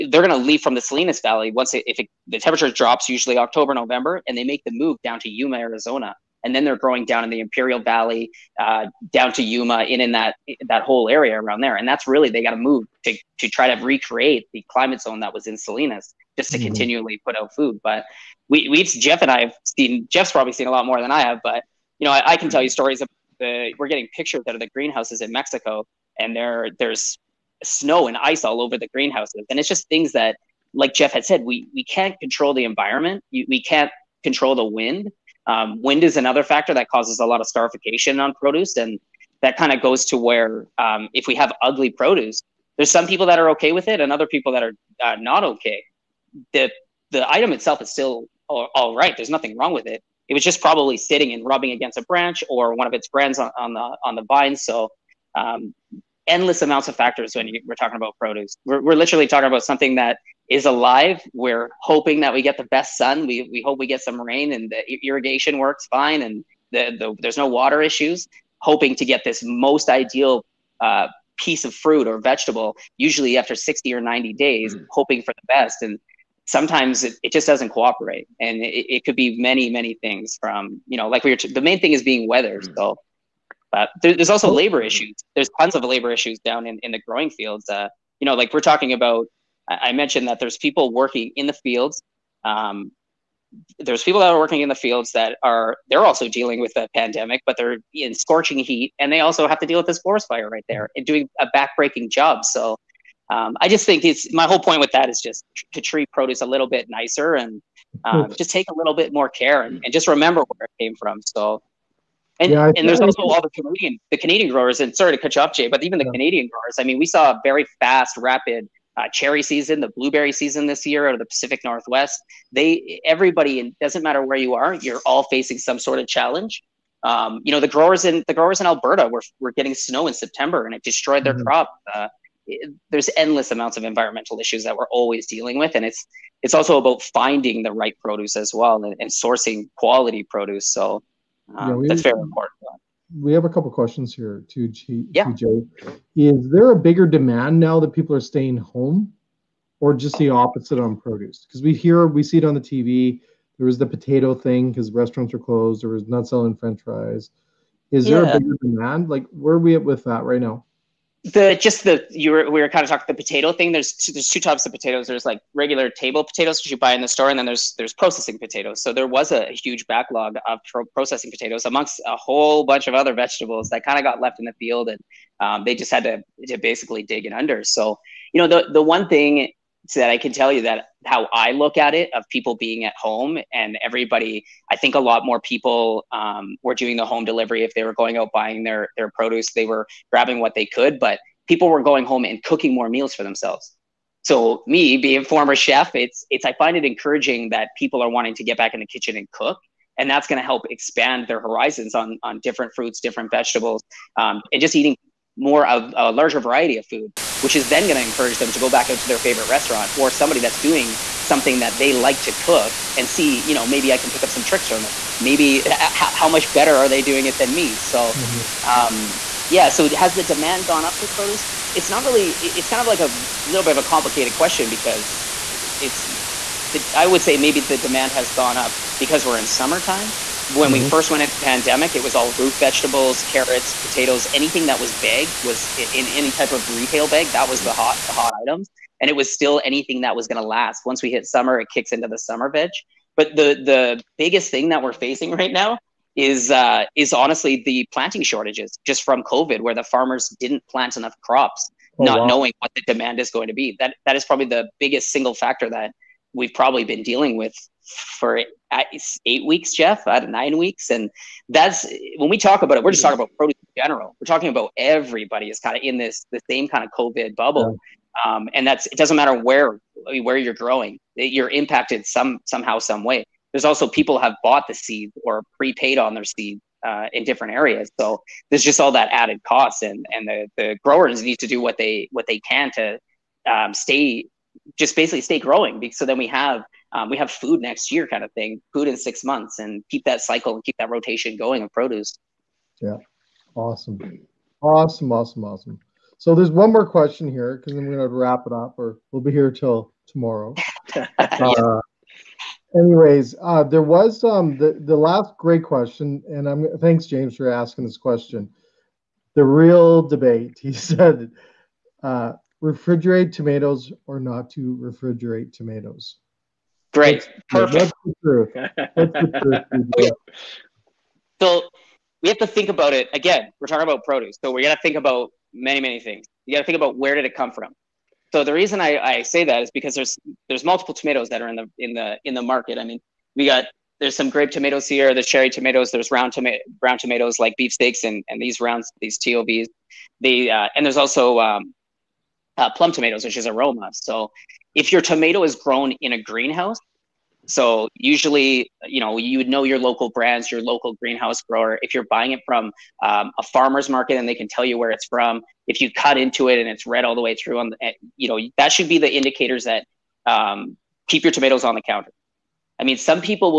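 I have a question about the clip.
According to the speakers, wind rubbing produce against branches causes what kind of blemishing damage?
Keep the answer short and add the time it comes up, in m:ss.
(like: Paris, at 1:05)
starification, at 0:37.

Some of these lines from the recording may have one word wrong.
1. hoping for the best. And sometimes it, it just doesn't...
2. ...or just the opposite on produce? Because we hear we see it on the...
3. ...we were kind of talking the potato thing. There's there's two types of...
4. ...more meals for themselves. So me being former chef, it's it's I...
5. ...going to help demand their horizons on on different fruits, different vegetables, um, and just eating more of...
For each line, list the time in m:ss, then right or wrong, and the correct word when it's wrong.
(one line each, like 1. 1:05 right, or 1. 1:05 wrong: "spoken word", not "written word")
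1. 1:14 right
2. 2:29 right
3. 2:42 right
4. 3:12 right
5. 3:20 wrong: "expand", not "demand".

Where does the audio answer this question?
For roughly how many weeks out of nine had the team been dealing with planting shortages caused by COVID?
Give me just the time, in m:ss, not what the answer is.
4:19.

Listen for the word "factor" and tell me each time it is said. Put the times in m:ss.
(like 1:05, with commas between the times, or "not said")
0:36, 0:56, 4:15.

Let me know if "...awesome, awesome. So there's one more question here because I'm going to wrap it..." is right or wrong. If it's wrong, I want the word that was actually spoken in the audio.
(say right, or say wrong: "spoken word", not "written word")
right.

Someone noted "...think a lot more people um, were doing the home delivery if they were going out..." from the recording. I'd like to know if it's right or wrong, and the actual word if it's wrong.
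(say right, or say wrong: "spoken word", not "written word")
right.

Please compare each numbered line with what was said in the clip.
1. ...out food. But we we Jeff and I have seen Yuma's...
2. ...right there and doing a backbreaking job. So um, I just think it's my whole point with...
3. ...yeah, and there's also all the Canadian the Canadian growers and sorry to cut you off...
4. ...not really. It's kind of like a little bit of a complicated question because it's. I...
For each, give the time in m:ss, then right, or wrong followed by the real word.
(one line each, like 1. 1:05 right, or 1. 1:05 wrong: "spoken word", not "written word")
1. 0:17 wrong: "Jeff", not "Yuma"
2. 1:40 right
3. 1:52 right
4. 3:41 right.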